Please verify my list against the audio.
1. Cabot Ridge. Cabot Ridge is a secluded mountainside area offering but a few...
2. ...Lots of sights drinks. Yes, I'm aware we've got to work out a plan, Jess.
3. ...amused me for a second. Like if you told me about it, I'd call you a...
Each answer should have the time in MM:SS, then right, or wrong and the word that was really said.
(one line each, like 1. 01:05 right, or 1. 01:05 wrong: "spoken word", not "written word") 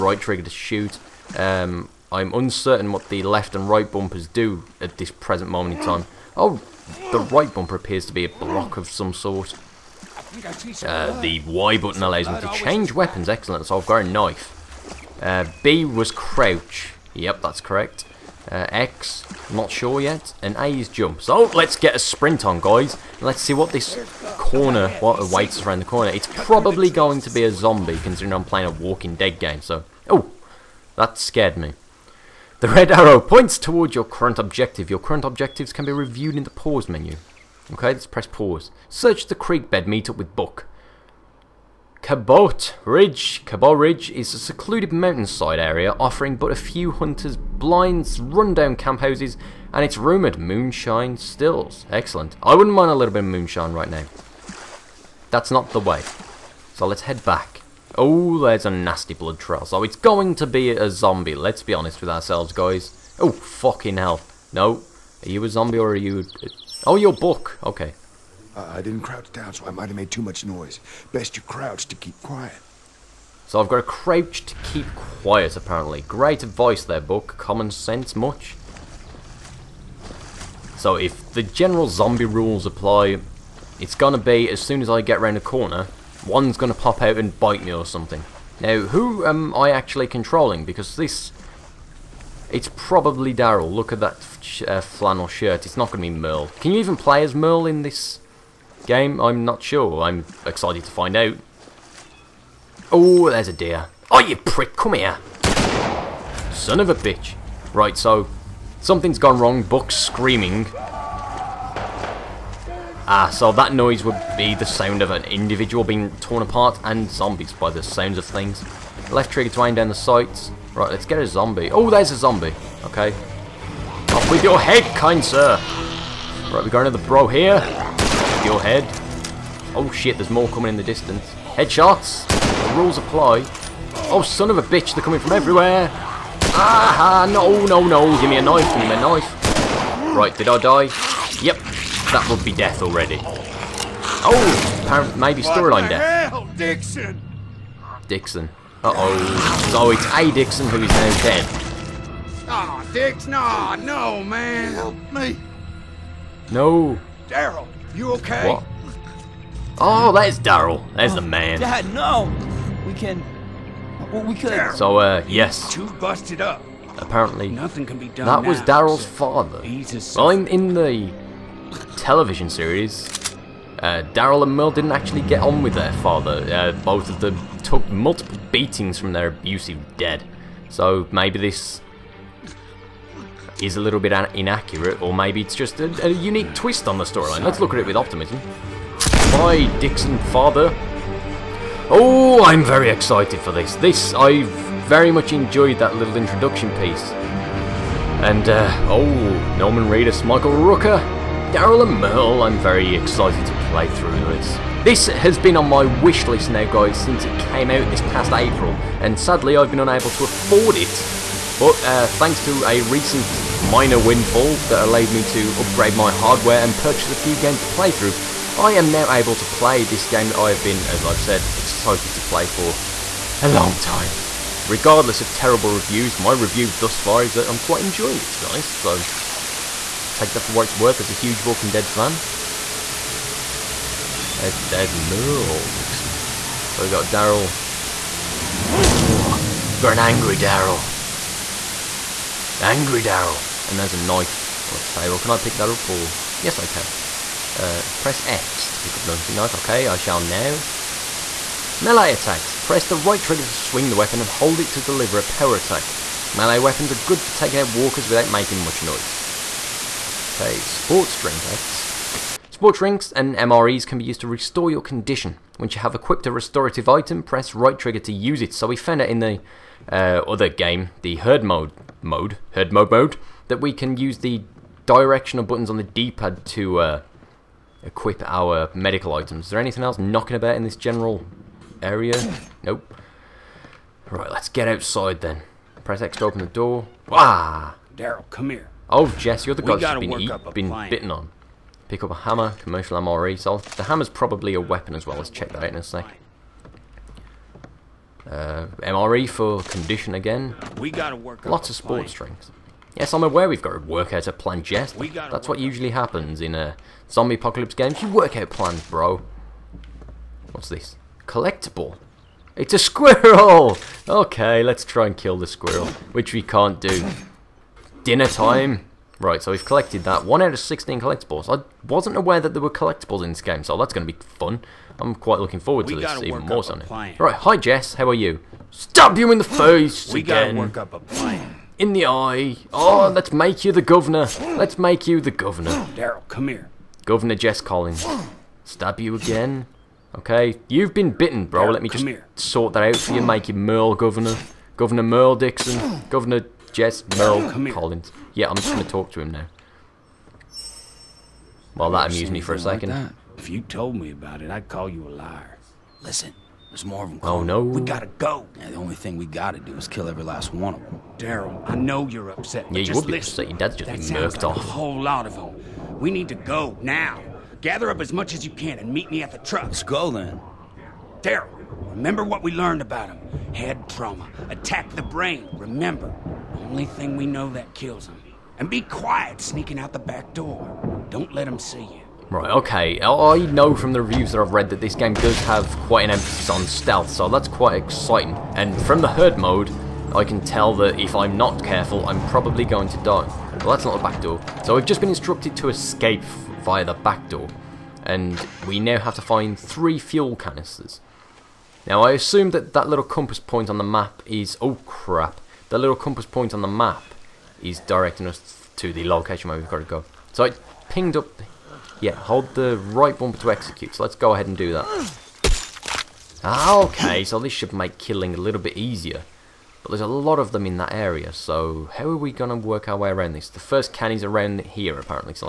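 1. 00:42 right
2. 05:01 wrong: "sports", not "sights"
3. 05:52 right.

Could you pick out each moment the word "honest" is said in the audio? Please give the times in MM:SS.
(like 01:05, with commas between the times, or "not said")
01:01, 03:48.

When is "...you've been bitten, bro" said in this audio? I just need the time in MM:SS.
05:40.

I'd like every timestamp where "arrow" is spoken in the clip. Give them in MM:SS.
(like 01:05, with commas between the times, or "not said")
00:32.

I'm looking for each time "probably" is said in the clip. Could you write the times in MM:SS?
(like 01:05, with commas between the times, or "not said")
00:26, 01:32, 04:54, 06:32.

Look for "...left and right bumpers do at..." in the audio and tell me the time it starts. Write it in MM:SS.
00:03.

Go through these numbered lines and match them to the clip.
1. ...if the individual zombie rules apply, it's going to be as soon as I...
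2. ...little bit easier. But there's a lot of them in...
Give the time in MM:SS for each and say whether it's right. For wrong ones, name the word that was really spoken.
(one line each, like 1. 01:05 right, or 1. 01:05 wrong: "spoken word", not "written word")
1. 01:20 wrong: "general", not "individual"
2. 06:58 right.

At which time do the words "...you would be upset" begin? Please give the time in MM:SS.
06:02.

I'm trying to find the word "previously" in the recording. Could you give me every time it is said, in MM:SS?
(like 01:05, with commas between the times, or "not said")
not said.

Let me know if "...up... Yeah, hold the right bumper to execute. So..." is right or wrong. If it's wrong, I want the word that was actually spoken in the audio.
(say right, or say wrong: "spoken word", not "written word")
right.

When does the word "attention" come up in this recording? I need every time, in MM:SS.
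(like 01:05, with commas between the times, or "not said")
not said.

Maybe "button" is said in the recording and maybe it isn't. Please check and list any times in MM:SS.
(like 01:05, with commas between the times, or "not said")
00:11, 04:35.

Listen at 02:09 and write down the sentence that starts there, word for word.
Oh shit, there's more coming in the distance.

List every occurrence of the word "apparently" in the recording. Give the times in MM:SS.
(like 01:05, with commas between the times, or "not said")
01:15, 02:46, 07:04.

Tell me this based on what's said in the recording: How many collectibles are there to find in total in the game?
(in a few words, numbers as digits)
16.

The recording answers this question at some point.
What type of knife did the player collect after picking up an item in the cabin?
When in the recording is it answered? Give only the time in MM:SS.
04:09.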